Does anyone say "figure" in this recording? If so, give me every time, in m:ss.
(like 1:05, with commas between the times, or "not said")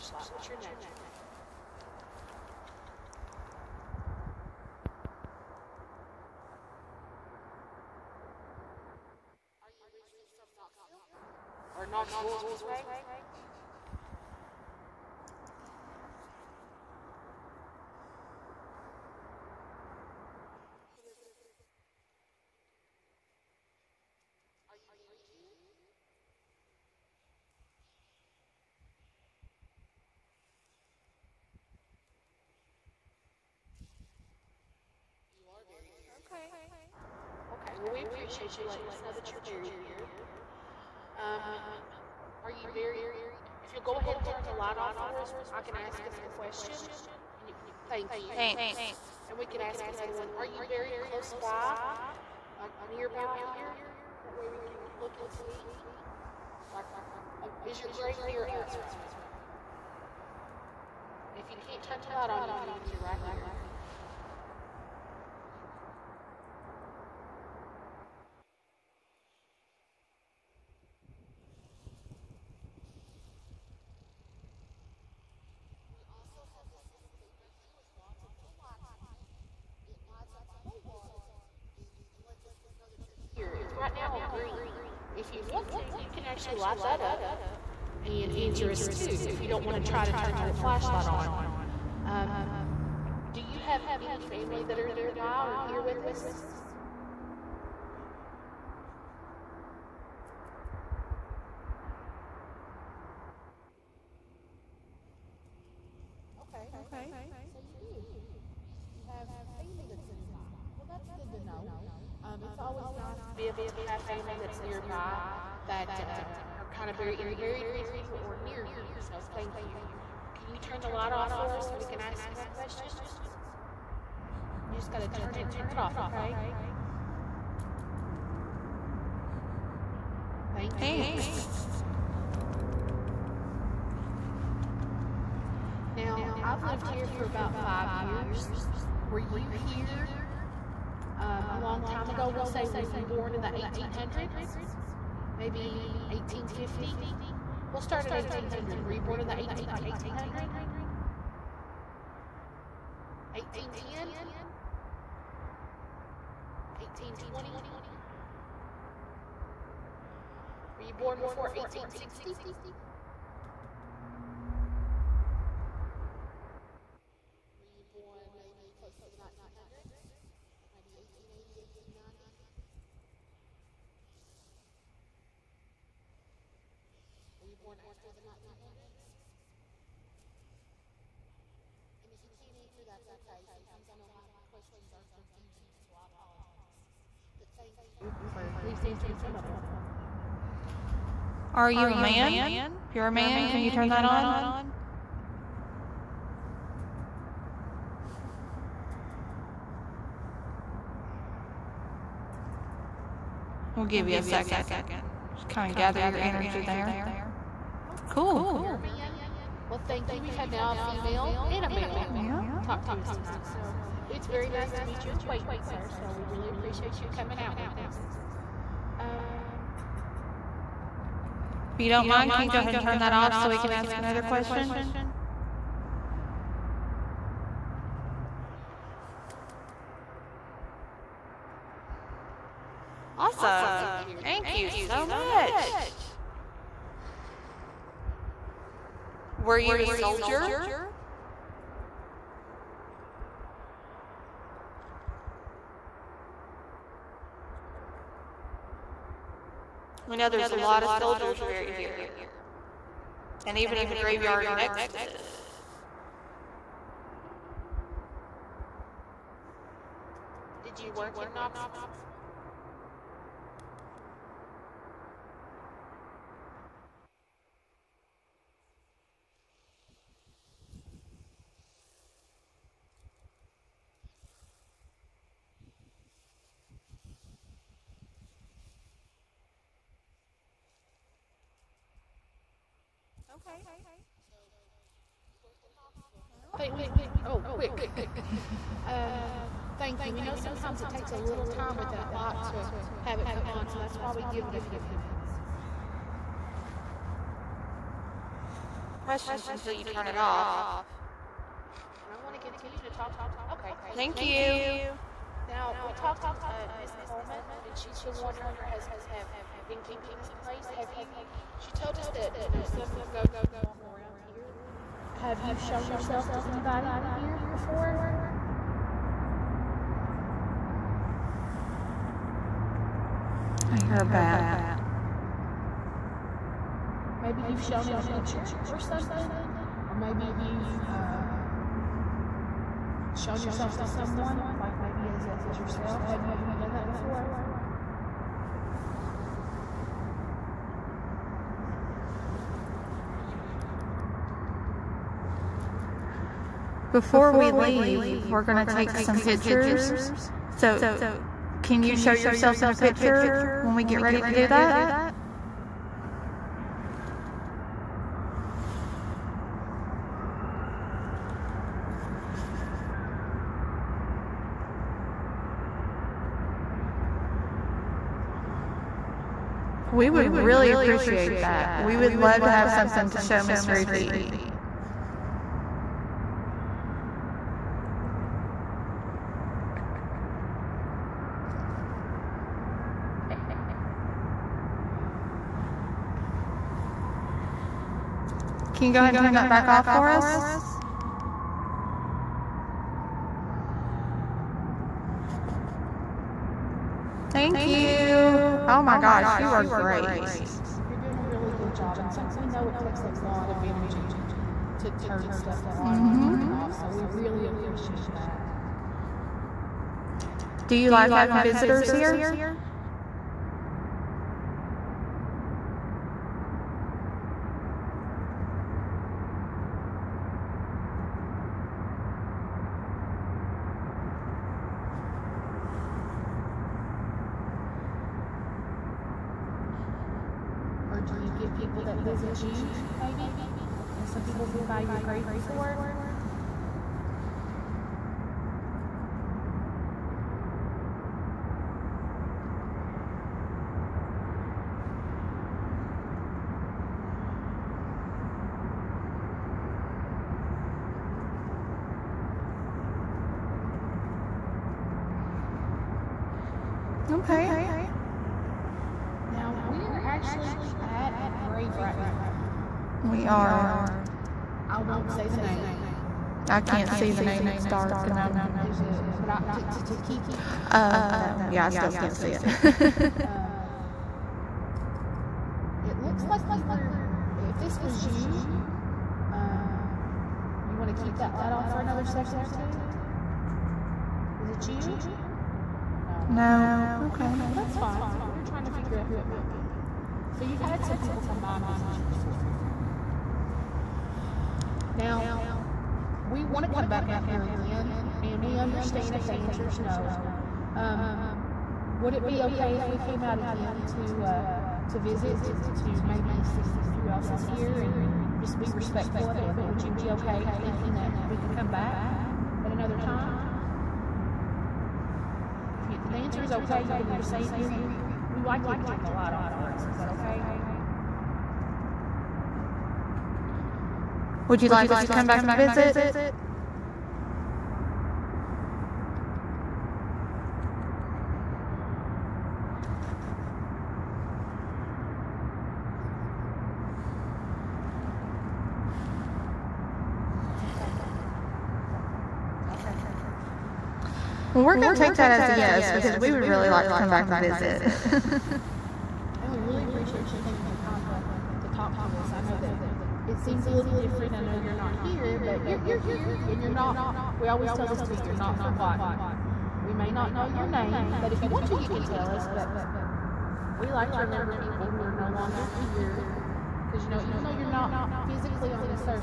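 8:08.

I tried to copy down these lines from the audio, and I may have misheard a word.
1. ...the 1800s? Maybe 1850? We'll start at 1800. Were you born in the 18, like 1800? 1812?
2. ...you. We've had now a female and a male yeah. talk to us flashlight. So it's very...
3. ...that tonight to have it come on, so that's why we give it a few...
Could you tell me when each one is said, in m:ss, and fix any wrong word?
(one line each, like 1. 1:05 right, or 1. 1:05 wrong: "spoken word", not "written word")
1. 2:23 wrong: "1810", not "1812"
2. 3:30 wrong: "tonight", not "flashlight"
3. 4:51 wrong: "light", not "tonight".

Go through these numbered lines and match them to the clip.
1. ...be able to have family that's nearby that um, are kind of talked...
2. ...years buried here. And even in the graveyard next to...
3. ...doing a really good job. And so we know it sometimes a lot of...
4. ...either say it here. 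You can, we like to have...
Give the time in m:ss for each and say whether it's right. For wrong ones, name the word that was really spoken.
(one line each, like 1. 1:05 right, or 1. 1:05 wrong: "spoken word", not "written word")
1. 1:53 wrong: "buried", not "talked"
2. 4:10 wrong: "soldiers", not "years"
3. 6:40 wrong: "takes", not "sometimes"
4. 8:37 right.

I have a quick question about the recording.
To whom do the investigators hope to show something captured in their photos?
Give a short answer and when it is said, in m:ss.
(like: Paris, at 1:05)
Miss Ruthie, at 6:13.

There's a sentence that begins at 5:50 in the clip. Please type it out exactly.
So, can you show yourself in a picture?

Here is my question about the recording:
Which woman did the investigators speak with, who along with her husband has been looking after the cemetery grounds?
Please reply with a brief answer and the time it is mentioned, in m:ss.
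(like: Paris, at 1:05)
Miss Coleman, at 5:06.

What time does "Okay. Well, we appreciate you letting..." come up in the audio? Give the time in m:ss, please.
0:37.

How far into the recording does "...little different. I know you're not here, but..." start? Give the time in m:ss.
9:13.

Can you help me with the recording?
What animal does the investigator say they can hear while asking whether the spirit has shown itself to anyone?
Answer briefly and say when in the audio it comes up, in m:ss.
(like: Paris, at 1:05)
A bat, at 5:23.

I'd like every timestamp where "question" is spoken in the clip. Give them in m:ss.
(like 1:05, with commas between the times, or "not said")
0:46, 2:02, 3:04, 3:44, 4:59.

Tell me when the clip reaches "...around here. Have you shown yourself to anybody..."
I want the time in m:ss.
5:13.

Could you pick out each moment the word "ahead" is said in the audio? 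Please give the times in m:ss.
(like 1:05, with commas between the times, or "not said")
0:44, 3:42, 6:28.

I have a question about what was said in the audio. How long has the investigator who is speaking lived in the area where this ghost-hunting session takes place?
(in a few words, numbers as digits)
About 5 years.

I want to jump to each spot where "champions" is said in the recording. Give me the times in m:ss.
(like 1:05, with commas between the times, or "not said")
not said.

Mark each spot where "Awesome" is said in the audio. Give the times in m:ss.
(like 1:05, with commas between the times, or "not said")
3:53.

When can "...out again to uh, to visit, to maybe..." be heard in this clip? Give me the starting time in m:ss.
8:23.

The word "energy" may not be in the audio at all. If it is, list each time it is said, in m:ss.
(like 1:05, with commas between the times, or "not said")
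3:26, 6:43.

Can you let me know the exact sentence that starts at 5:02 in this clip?
And I want to continue to talk.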